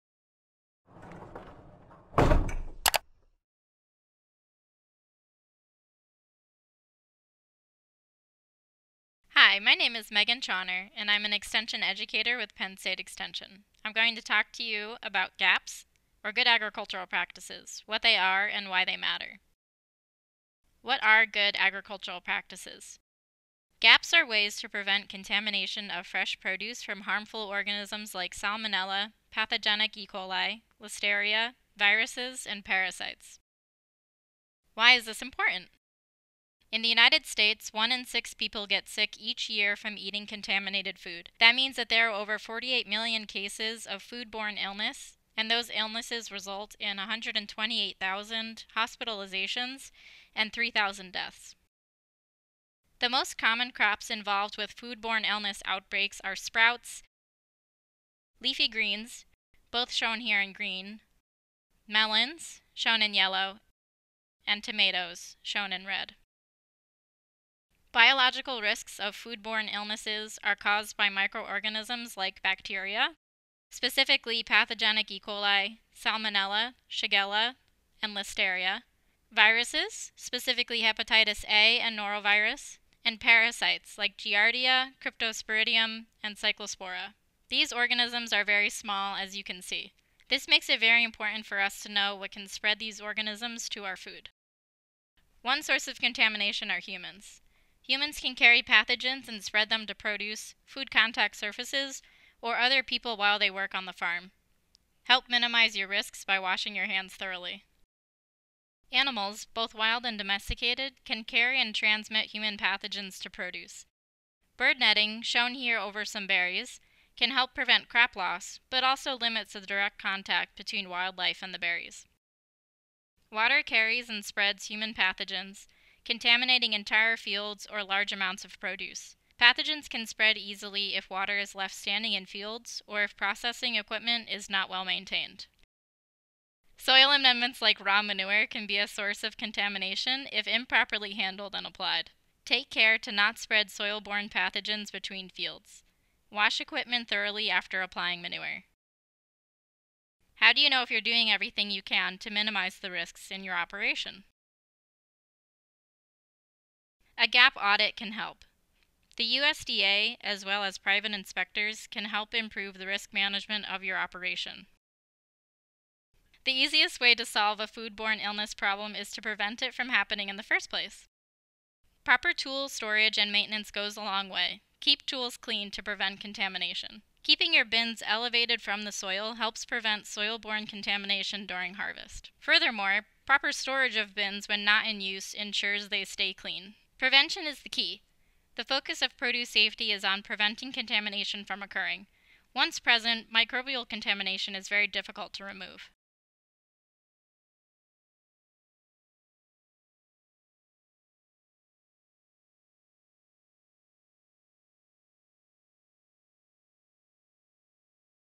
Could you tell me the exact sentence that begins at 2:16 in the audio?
Soil amendments like raw manure can be a source of contamination if improperly handled and applied.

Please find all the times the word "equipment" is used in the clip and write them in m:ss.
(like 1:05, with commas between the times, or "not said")
2:13, 2:26.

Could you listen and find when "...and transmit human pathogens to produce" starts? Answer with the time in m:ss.
1:51.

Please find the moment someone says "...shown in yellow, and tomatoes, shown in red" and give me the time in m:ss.
1:02.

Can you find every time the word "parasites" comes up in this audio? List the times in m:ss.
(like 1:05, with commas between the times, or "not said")
0:32, 1:23.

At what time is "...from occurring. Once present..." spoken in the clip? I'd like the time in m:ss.
3:11.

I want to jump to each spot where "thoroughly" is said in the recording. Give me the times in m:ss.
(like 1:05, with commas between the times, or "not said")
1:47, 2:27.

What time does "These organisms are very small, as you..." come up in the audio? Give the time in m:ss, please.
1:27.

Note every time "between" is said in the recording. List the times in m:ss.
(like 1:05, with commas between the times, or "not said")
2:00, 2:24.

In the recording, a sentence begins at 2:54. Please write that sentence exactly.
Keep tools clean to prevent contamination.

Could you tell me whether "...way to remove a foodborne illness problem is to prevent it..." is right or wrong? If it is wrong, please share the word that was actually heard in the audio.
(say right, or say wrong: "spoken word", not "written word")
wrong: "solve", not "remove".